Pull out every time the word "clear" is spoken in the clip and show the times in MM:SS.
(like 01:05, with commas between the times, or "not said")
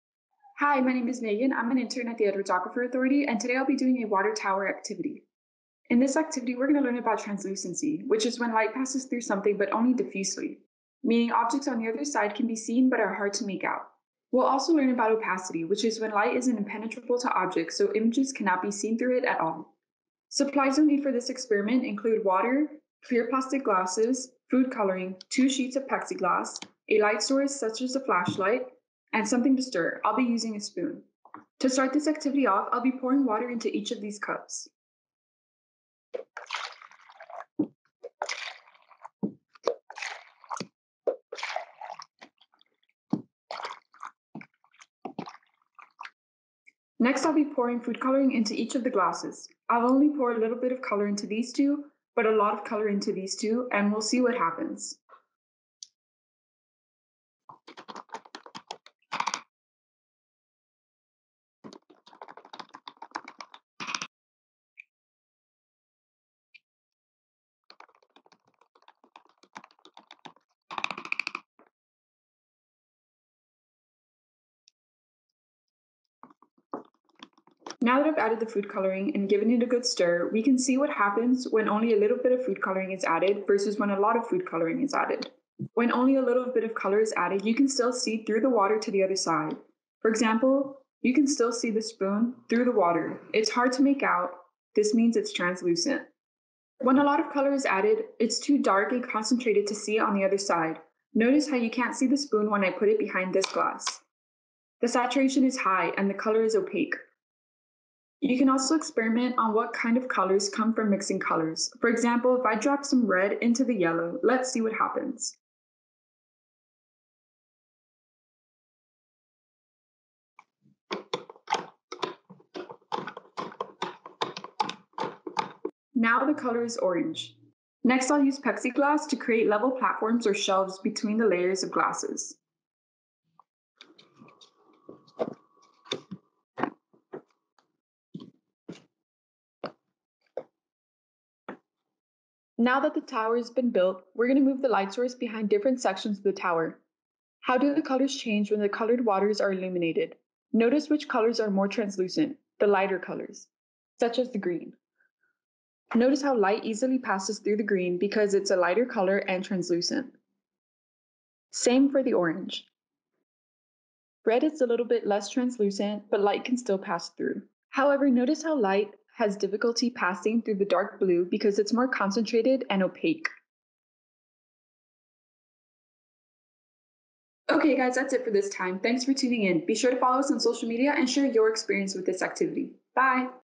00:23.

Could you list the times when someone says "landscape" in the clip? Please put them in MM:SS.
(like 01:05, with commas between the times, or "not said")
not said.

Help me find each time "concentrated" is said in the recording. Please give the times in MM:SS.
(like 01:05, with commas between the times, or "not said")
01:39, 02:51.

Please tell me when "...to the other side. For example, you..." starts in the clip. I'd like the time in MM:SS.
01:28.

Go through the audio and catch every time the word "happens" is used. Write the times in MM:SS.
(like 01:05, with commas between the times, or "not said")
00:54, 01:20, 01:54.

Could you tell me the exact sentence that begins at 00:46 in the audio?
Next, I'll be pouring food coloring into each of the glasses.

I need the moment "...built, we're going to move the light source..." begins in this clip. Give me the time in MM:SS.
02:23.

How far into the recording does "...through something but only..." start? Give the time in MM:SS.
00:09.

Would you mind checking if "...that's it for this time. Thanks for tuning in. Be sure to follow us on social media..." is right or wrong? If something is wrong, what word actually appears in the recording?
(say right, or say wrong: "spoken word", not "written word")
right.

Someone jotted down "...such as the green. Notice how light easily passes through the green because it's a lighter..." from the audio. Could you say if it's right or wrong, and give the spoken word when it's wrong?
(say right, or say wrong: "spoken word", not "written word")
right.